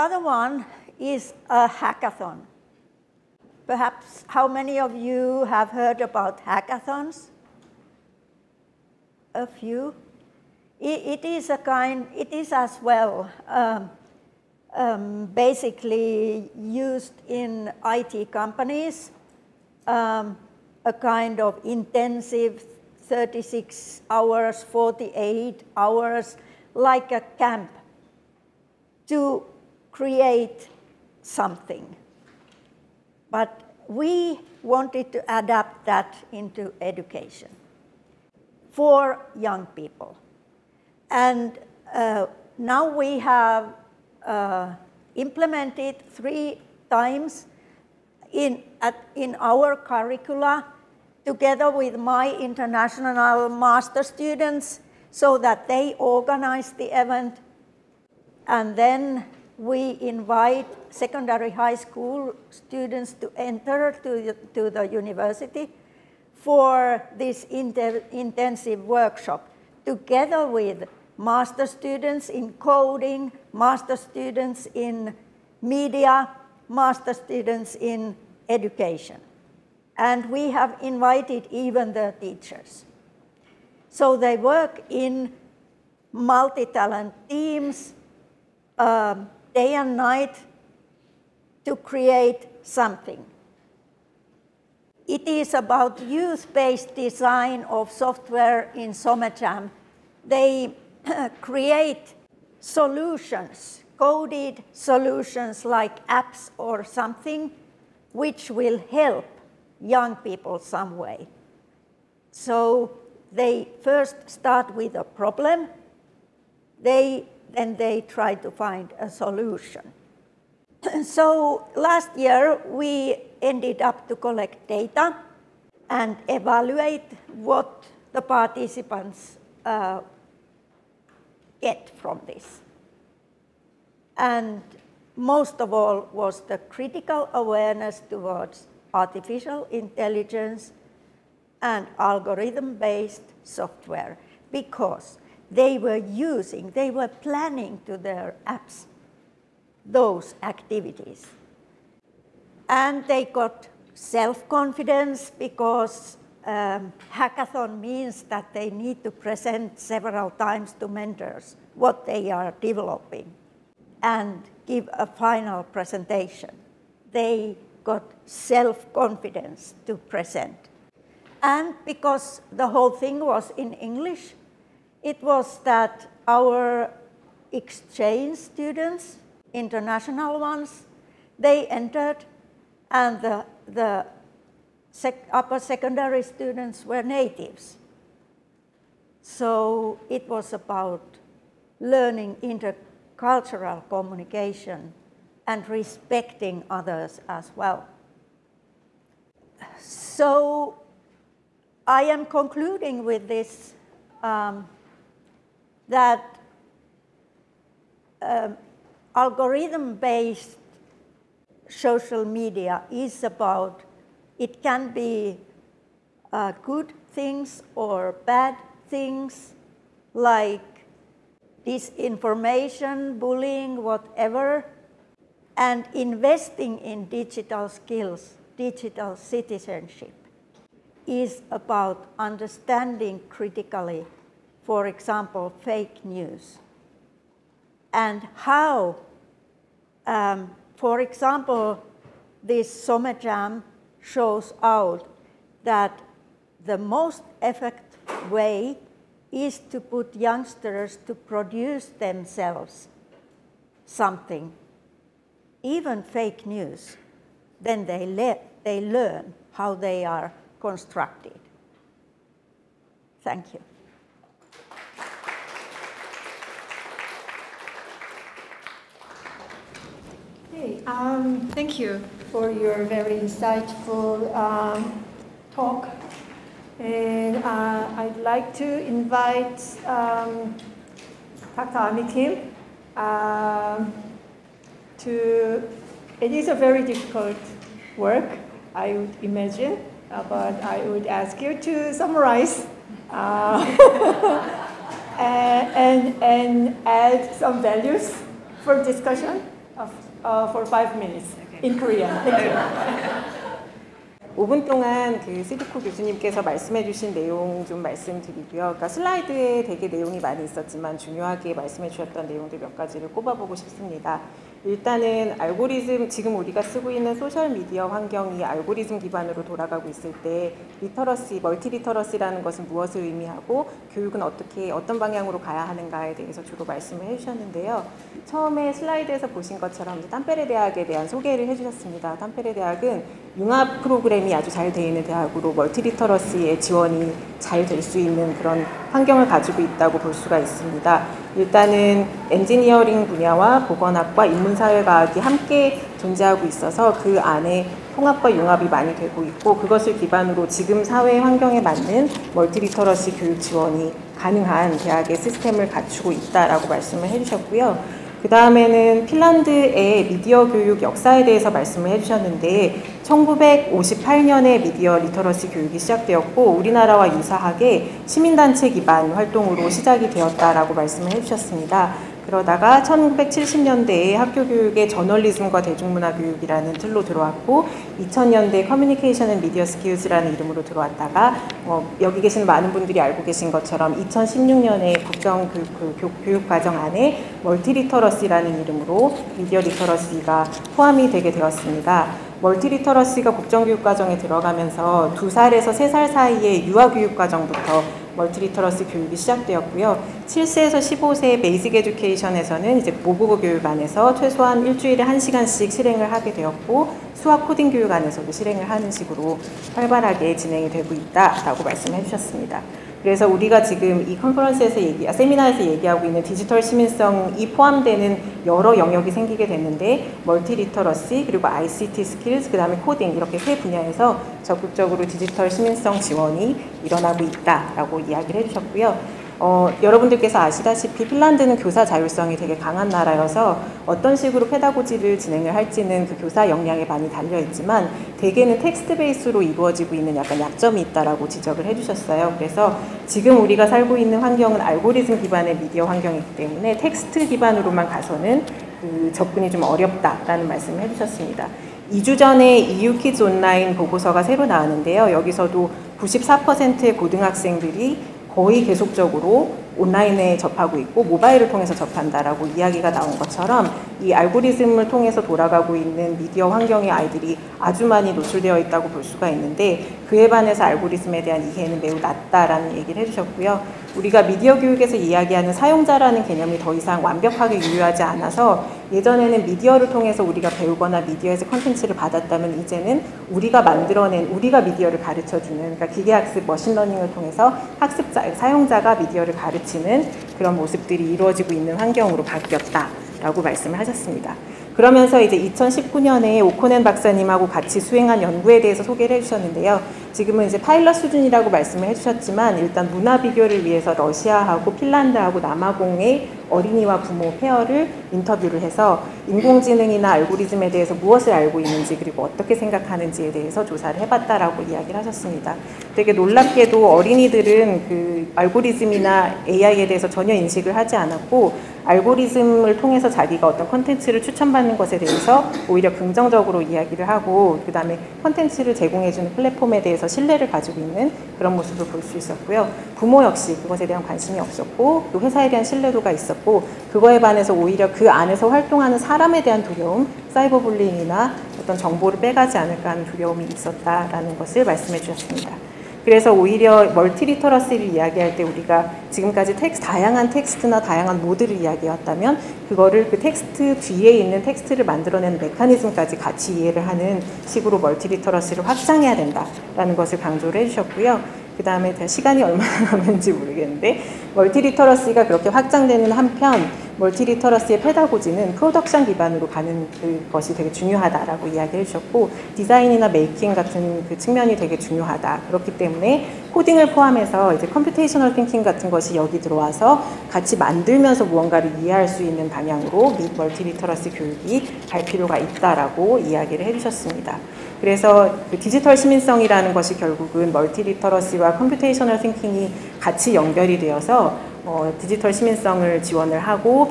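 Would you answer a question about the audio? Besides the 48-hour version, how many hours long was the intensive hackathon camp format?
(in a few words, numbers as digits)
36 hours.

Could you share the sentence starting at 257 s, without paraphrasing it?
Then they, le they learn how they are constructed.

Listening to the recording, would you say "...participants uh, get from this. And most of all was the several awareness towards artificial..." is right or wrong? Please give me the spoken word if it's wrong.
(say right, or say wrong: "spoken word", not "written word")
wrong: "critical", not "several".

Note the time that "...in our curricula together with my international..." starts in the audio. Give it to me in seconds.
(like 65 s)
49 s.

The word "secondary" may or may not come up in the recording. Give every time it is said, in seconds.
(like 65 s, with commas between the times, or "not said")
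60 s, 185 s.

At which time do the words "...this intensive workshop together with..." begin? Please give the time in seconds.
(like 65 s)
67 s.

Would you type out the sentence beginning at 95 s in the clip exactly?
It is about use-based design of software in SomaJam.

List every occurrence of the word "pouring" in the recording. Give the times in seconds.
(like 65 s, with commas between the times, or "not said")
not said.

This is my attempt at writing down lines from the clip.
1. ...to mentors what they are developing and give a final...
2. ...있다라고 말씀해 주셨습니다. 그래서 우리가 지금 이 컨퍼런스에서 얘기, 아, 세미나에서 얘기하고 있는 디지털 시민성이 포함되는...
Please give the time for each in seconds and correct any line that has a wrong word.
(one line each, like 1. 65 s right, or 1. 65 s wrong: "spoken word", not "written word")
1. 160 s right
2. 410 s right.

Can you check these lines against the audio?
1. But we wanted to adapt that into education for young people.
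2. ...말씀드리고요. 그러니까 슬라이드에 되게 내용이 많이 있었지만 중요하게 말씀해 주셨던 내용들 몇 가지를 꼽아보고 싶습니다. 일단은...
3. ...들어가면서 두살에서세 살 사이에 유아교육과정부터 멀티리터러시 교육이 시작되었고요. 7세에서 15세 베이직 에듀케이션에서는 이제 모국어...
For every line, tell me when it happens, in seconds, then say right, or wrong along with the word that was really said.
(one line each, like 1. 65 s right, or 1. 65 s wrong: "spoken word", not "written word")
1. 33 s right
2. 307 s right
3. 394 s right.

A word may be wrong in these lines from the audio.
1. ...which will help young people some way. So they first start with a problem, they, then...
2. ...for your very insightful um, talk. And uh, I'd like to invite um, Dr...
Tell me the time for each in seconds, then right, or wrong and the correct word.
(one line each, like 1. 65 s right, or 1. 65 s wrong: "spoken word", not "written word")
1. 108 s right
2. 272 s right.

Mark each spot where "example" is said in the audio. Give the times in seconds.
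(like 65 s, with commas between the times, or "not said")
234 s, 240 s.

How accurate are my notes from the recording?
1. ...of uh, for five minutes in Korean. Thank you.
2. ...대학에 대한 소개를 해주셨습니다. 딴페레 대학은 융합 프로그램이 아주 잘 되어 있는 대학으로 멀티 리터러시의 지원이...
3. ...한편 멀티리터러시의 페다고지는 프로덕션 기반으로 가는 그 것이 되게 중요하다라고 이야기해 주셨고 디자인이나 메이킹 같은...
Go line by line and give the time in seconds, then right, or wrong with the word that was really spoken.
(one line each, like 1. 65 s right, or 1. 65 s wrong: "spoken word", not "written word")
1. 299 s right
2. 330 s right
3. 566 s right.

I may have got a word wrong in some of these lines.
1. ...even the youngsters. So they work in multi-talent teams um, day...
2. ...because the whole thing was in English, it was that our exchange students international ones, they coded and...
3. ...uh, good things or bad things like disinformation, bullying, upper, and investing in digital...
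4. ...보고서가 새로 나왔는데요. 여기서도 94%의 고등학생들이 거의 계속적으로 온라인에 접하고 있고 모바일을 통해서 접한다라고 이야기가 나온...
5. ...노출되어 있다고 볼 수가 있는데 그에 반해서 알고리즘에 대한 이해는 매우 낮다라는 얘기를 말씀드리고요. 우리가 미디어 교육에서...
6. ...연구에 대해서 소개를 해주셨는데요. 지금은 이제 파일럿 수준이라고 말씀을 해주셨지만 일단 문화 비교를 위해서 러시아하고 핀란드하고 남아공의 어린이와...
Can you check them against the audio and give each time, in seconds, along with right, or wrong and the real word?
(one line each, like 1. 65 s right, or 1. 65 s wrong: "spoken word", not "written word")
1. 81 s wrong: "teachers", not "youngsters"
2. 171 s wrong: "entered", not "coded"
3. 216 s wrong: "whatever", not "upper"
4. 453 s right
5. 468 s wrong: "해주셨고요", not "말씀드리고요"
6. 498 s right.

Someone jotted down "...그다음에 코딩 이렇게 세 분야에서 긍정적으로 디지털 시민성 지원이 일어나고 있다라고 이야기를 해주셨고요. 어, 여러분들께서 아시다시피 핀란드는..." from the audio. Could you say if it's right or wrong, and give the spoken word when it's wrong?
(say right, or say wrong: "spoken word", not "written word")
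wrong: "적극적으로", not "긍정적으로".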